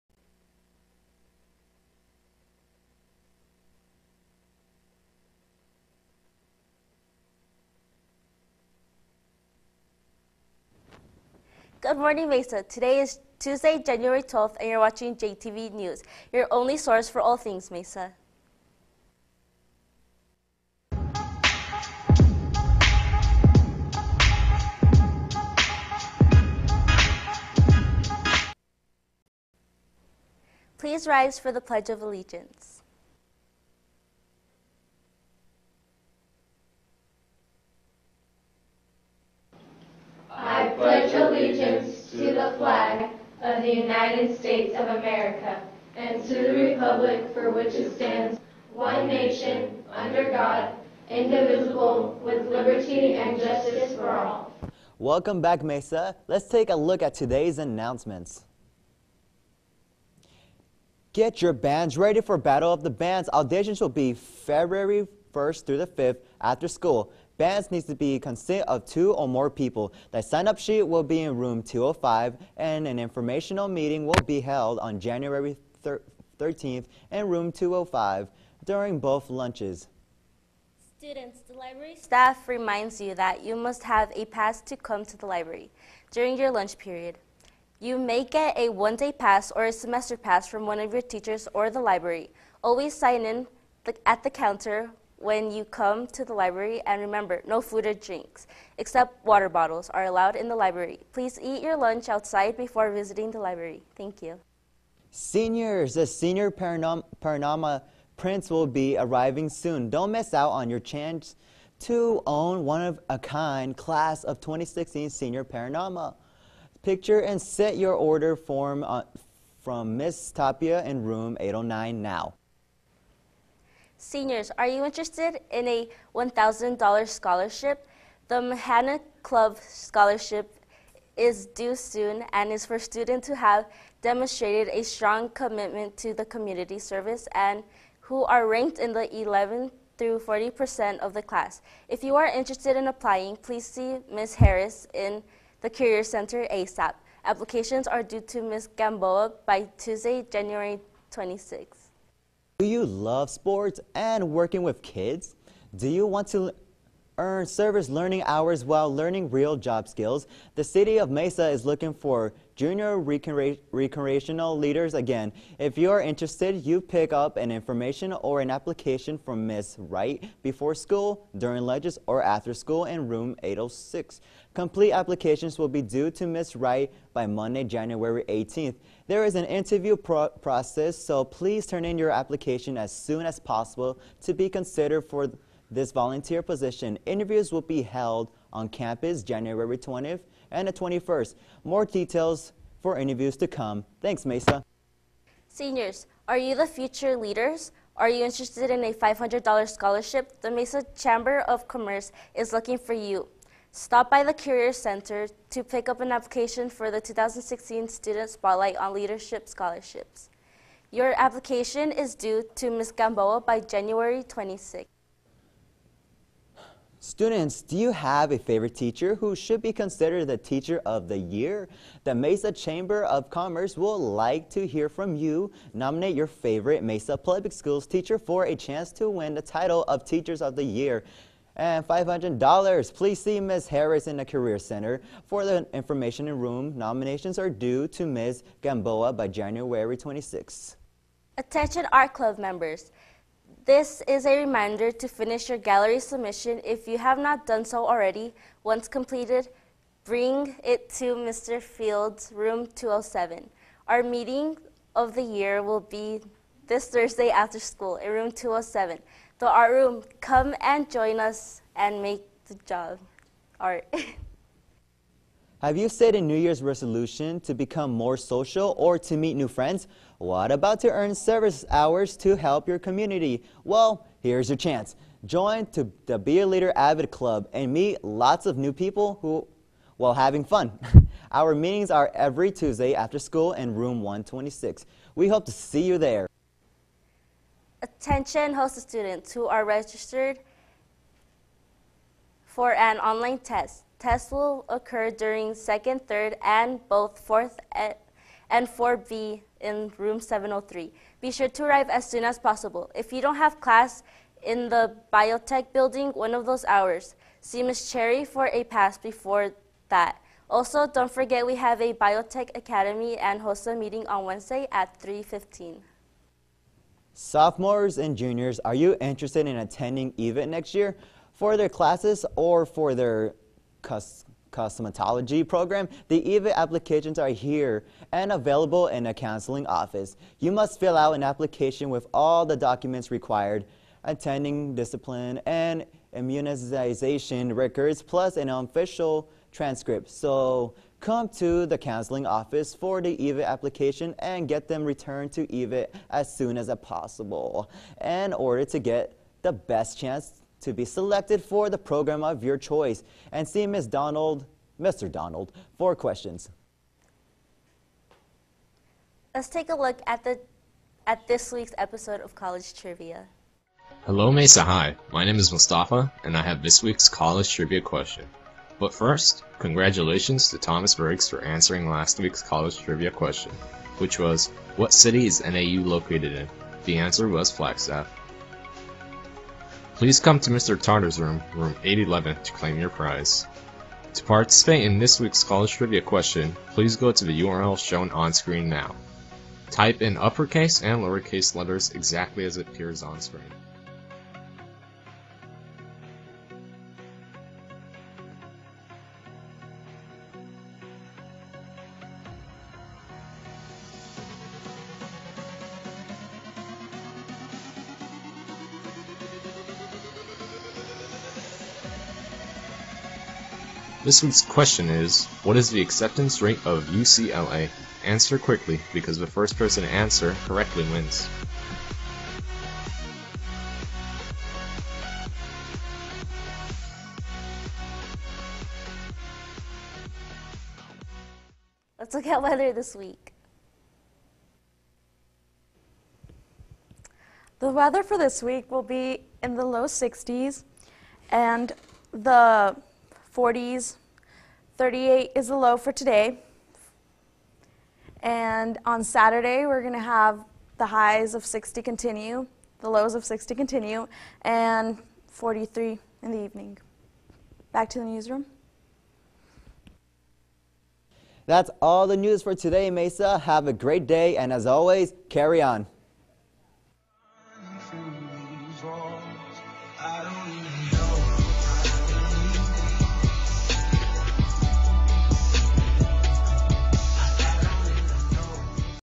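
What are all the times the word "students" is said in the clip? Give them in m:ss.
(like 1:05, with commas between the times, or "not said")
1:20, 2:12, 3:27, 3:37, 4:48.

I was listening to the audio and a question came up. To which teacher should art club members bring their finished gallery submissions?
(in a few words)
Mr. Fields.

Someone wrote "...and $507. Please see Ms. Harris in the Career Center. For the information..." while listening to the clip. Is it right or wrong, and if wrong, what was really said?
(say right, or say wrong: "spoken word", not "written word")
wrong: "500", not "507".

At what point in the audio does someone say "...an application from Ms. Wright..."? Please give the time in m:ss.
2:48.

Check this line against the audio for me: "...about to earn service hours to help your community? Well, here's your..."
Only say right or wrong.
right.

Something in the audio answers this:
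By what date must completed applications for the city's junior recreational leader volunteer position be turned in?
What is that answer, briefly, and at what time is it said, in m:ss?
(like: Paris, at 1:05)
Monday, January 18th, at 2:57.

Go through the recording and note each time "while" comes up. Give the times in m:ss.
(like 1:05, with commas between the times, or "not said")
2:38, 4:39.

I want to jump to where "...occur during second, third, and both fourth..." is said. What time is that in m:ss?
4:54.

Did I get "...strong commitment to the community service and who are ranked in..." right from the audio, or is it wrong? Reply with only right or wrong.
right.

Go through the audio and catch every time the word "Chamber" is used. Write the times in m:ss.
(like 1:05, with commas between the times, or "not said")
3:20, 3:42.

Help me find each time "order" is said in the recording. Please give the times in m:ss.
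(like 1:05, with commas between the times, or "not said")
1:57, 5:48.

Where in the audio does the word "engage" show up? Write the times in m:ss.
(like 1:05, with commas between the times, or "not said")
not said.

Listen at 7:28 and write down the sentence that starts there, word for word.
And on Saturday, we're going to have the highs of 60 continue, the lows of 60 continue, and 43 in the evening.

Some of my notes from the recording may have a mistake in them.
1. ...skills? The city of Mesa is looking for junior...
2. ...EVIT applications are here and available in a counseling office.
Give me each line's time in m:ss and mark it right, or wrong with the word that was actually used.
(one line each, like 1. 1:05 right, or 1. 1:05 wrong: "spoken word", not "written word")
1. 2:39 right
2. 5:26 right.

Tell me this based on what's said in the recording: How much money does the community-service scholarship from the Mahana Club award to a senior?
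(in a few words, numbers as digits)
$1,000.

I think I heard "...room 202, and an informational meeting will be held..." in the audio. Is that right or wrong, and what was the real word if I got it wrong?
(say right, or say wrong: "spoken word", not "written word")
wrong: "205", not "202".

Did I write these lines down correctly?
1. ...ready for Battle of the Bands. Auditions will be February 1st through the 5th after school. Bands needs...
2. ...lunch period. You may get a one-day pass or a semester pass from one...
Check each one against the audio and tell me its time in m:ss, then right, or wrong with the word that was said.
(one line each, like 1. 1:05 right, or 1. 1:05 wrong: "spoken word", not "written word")
1. 1:01 right
2. 1:26 right.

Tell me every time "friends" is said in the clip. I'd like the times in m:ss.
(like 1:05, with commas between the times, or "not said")
4:29.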